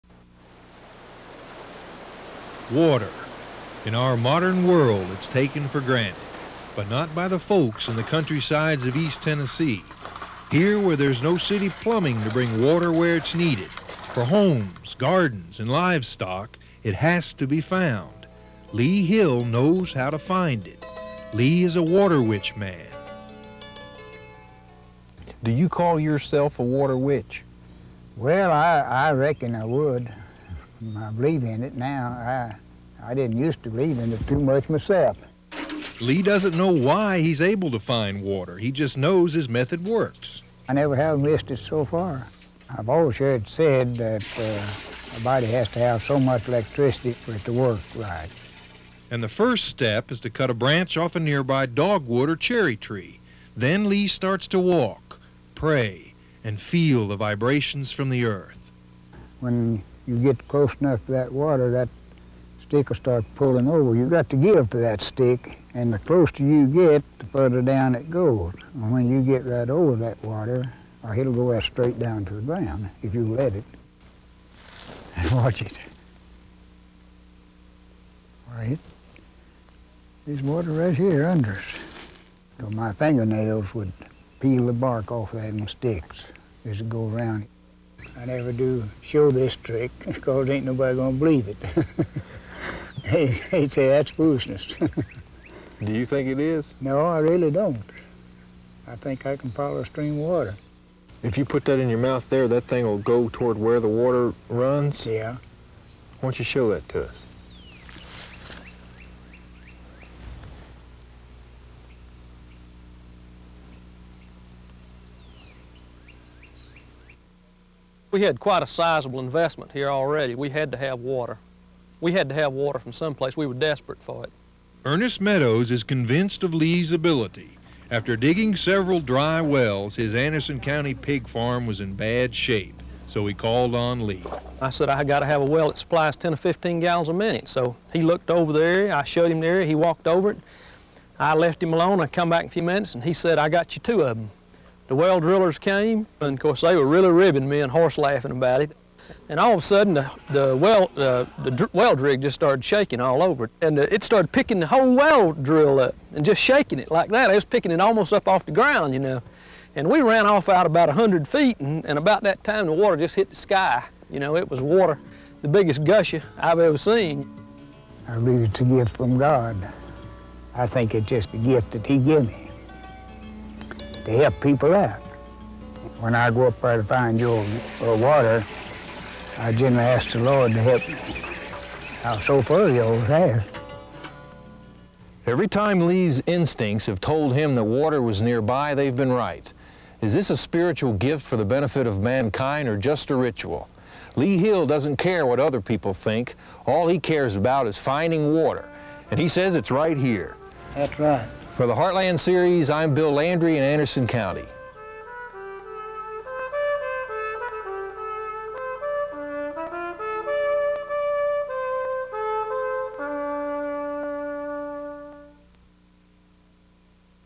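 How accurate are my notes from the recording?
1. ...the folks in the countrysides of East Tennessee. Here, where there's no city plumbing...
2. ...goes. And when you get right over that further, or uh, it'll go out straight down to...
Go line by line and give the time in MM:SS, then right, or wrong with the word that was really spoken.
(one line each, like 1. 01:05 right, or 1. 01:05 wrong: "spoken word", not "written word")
1. 00:07 right
2. 01:08 wrong: "water", not "further".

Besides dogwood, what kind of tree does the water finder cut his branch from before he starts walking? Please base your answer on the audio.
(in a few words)
cherry.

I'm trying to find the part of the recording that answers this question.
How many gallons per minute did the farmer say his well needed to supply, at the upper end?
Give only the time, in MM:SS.
02:16.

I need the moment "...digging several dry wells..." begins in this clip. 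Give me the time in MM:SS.
02:08.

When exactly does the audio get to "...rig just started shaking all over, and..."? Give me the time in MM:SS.
02:31.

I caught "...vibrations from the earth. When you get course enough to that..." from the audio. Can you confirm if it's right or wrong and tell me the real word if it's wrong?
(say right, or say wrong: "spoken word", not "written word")
wrong: "close", not "course".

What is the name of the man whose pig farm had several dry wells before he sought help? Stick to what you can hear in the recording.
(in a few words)
Ernest Meadows.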